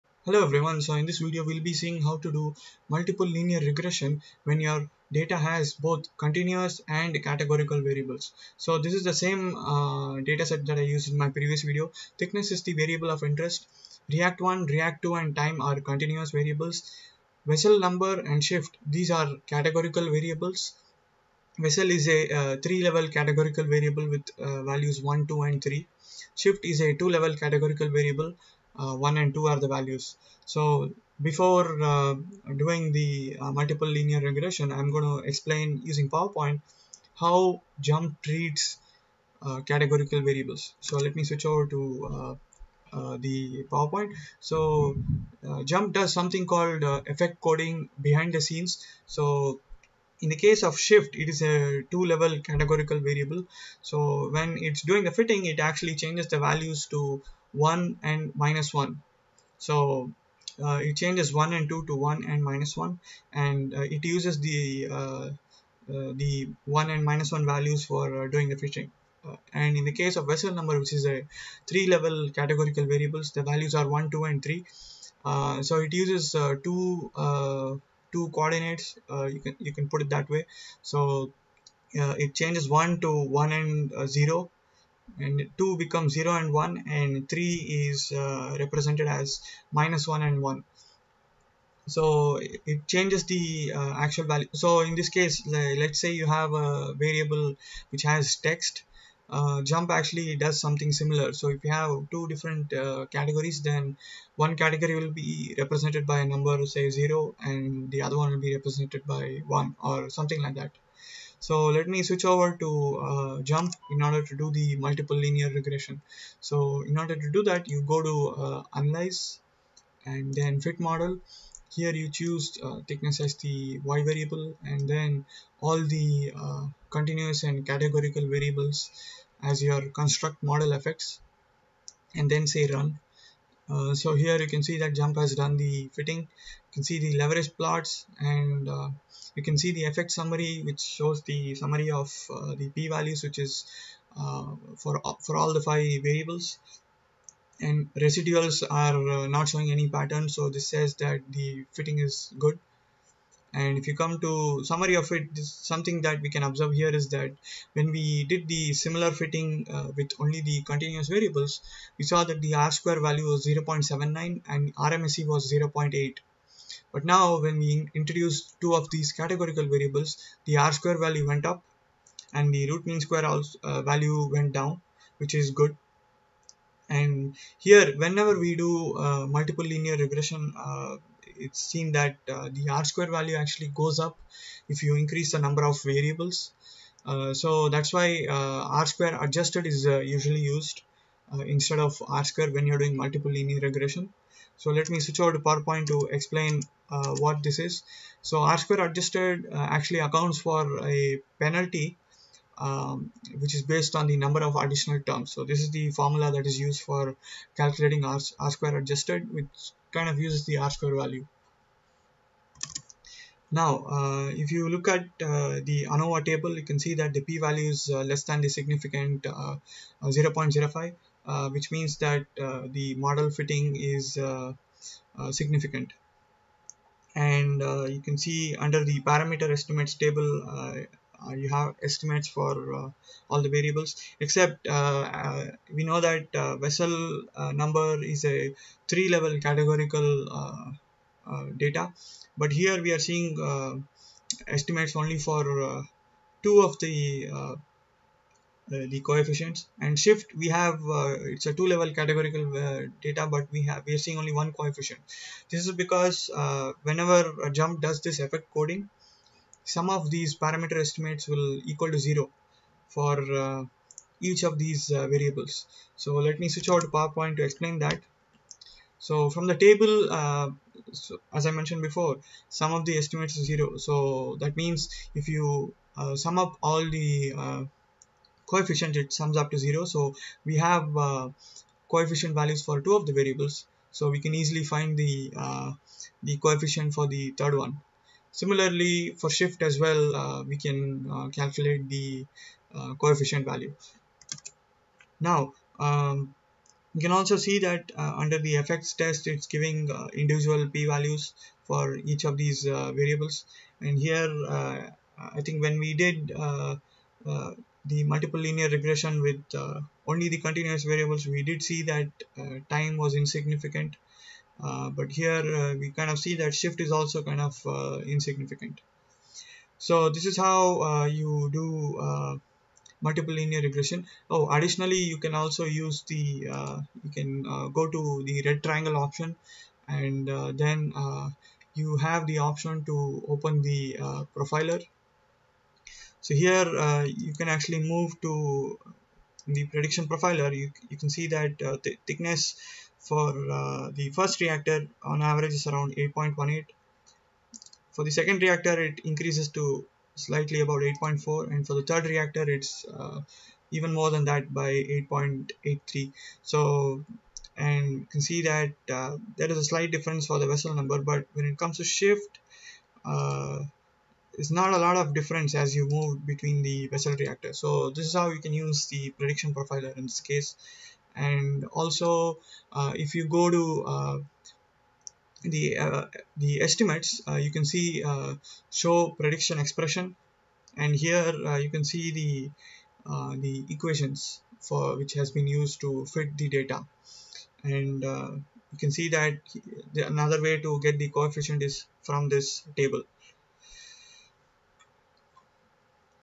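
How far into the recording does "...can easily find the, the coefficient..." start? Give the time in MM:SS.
04:44.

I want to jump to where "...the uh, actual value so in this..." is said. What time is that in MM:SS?
01:33.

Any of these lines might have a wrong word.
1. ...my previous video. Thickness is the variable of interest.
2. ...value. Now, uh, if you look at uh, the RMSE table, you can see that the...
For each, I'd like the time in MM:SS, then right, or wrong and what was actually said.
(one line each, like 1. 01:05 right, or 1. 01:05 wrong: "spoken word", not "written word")
1. 00:11 right
2. 03:30 wrong: "ANOVA", not "RMSE".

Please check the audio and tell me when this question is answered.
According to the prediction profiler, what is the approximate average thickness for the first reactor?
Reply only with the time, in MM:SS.
05:45.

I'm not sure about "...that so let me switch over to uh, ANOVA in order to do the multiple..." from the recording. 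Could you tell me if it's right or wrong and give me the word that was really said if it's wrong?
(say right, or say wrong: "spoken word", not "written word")
wrong: "JMP", not "ANOVA".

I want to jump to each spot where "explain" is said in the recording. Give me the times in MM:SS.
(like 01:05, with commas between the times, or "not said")
00:35, 03:16, 04:27.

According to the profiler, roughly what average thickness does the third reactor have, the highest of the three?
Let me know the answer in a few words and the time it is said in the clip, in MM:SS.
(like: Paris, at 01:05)
8.83, at 05:55.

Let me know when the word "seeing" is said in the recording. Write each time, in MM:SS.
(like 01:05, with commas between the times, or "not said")
00:01, 04:03, 04:14.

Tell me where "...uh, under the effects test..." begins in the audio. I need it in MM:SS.
04:57.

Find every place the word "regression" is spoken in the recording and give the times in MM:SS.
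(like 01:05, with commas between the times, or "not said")
00:03, 00:34, 01:55, 02:59, 03:13, 05:08, 05:23.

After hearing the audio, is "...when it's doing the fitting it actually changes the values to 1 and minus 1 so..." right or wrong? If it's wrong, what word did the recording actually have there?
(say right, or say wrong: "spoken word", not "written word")
right.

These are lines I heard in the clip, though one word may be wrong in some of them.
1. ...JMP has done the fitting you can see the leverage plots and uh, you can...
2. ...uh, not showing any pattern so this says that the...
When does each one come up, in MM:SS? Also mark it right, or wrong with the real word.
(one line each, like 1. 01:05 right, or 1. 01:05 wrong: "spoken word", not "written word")
1. 02:14 right
2. 02:29 right.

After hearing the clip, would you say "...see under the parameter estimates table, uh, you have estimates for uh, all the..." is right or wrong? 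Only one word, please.
right.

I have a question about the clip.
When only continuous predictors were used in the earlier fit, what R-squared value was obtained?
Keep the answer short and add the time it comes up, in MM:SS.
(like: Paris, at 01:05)
0.79, at 02:43.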